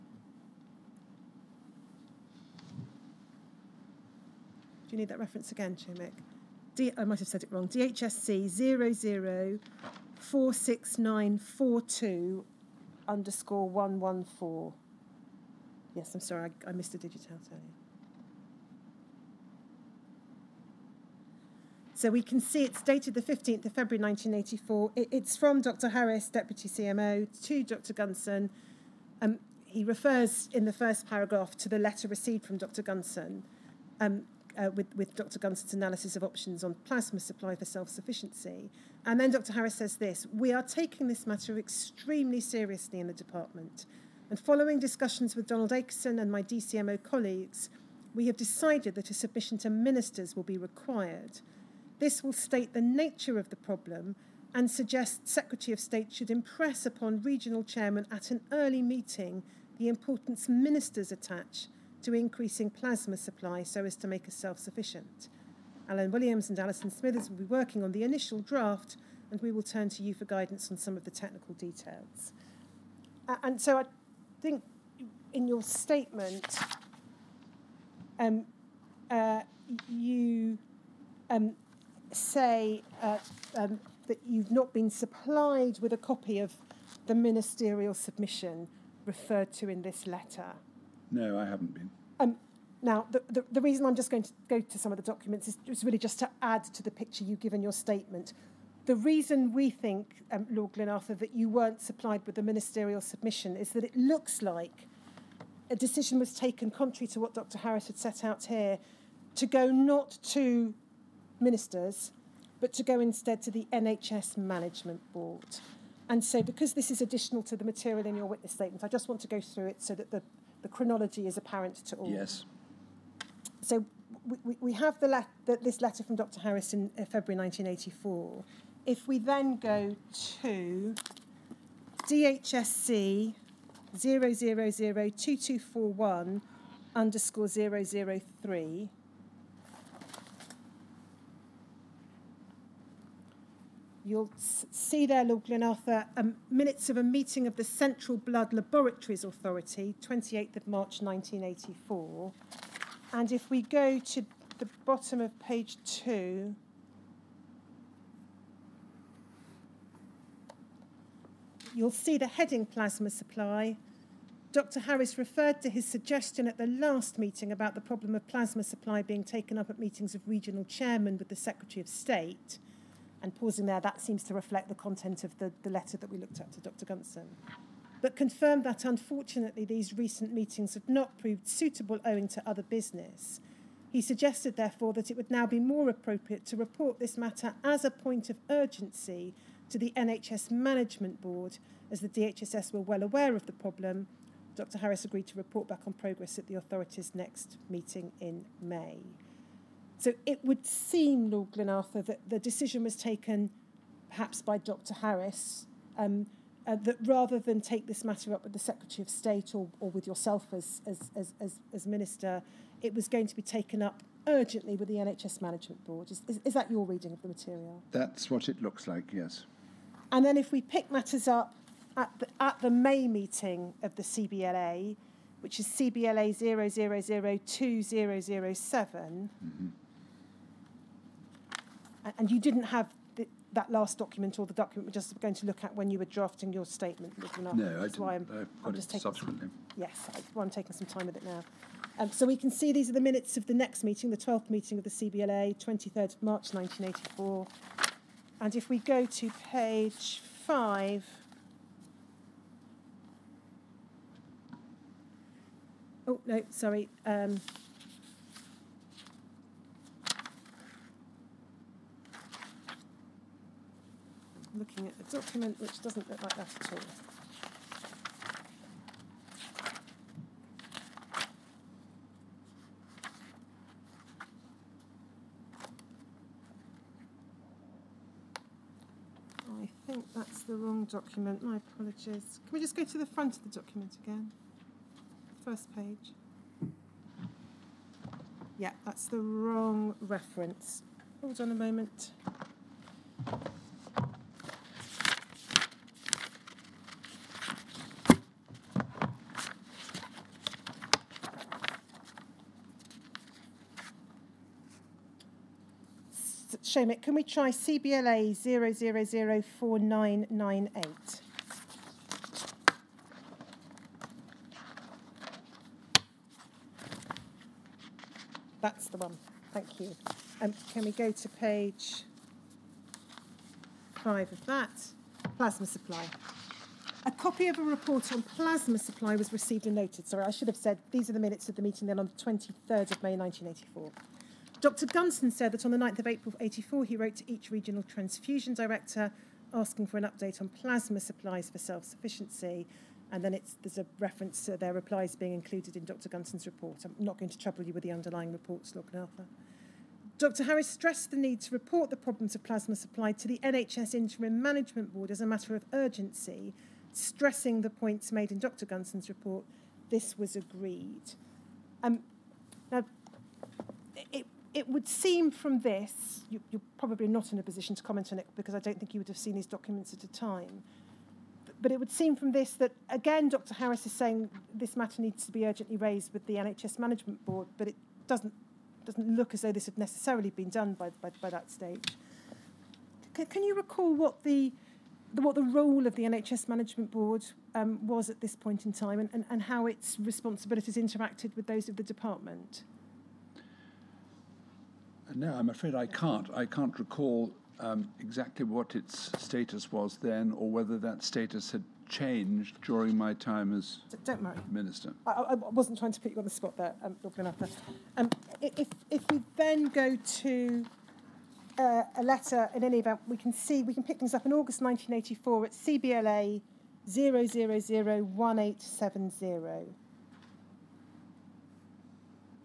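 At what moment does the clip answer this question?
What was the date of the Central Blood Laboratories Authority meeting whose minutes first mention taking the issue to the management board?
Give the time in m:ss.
2:30.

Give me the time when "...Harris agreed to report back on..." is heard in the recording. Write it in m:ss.
3:14.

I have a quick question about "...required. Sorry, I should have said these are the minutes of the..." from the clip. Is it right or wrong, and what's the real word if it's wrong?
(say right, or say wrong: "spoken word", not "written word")
wrong: "noted", not "required".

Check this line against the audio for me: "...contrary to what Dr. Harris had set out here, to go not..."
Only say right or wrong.
right.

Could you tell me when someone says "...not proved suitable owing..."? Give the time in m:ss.
3:00.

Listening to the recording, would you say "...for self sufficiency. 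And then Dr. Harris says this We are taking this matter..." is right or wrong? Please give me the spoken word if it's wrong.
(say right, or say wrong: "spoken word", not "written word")
right.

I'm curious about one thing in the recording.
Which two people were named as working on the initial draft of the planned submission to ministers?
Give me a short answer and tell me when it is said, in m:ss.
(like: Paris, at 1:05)
Alan Williams and Alison Smithers, at 1:05.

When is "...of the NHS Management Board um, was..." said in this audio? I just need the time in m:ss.
6:25.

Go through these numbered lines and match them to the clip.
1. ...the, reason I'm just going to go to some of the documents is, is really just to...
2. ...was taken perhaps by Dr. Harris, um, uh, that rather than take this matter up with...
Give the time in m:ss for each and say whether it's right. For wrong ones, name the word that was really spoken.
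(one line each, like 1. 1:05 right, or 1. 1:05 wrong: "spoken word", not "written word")
1. 1:33 right
2. 3:22 right.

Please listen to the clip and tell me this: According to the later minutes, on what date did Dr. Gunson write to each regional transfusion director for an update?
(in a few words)
9 April 1984.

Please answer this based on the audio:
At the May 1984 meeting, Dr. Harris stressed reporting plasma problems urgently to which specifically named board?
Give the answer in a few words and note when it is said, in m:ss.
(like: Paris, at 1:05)
NHS Interim Management Board, at 5:53.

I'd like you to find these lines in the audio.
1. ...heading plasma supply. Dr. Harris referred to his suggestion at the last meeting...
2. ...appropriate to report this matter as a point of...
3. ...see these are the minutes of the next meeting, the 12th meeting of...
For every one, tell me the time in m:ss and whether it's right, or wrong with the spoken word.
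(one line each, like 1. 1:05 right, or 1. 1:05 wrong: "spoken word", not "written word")
1. 2:42 right
2. 3:05 right
3. 4:02 right.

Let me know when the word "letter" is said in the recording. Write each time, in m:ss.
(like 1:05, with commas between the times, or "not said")
0:31, 1:30, 2:05, 2:55, 6:52.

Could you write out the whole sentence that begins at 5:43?
And then there's a reference to their replies being included in Dr.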